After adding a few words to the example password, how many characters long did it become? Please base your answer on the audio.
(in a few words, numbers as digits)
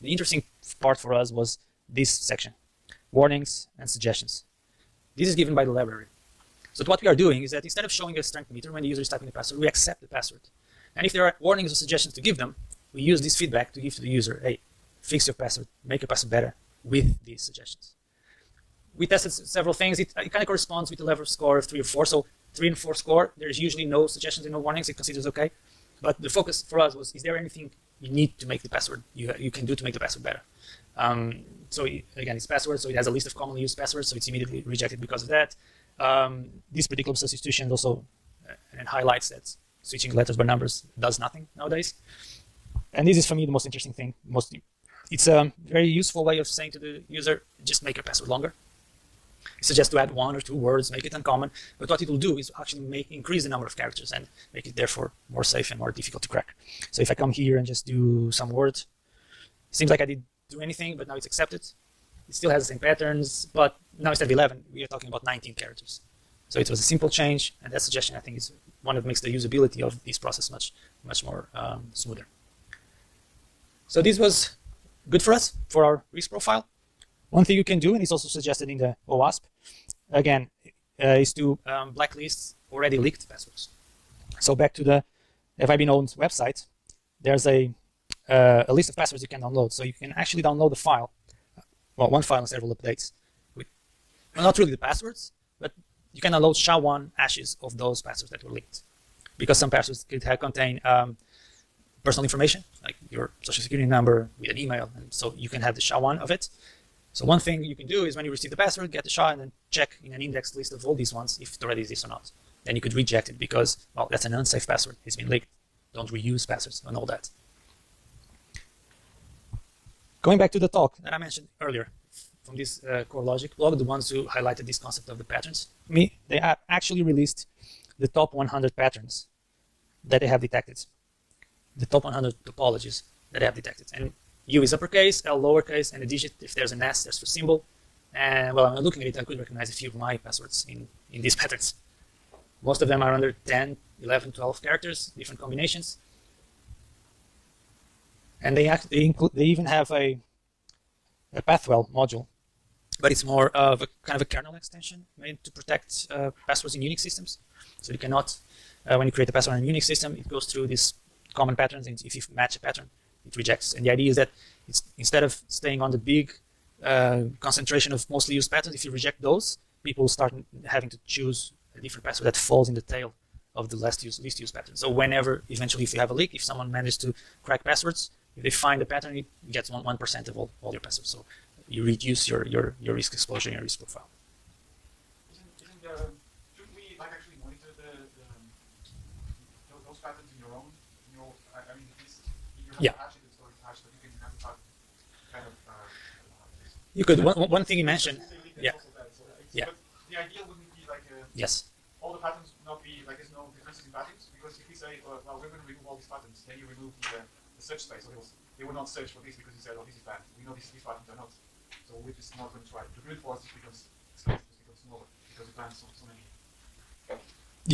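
19.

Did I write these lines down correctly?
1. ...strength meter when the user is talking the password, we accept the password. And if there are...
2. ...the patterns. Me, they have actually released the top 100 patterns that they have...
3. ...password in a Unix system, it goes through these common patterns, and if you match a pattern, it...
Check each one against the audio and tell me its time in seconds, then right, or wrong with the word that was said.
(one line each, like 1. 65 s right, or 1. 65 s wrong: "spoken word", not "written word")
1. 8 s wrong: "typing", not "talking"
2. 125 s right
3. 159 s right.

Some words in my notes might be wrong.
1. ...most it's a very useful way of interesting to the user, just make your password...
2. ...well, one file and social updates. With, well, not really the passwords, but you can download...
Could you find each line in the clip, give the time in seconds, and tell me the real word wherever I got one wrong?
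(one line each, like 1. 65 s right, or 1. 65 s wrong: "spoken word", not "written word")
1. 44 s wrong: "saying", not "interesting"
2. 91 s wrong: "several", not "social".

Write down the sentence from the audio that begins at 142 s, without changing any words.
Most of them are under 10, 11, 12 characters, different combinations.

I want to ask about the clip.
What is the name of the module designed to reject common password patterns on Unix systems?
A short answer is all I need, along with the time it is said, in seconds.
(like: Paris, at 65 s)
Pathwell, at 151 s.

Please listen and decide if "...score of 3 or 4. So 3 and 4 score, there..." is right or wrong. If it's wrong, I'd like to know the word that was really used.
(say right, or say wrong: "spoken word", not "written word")
right.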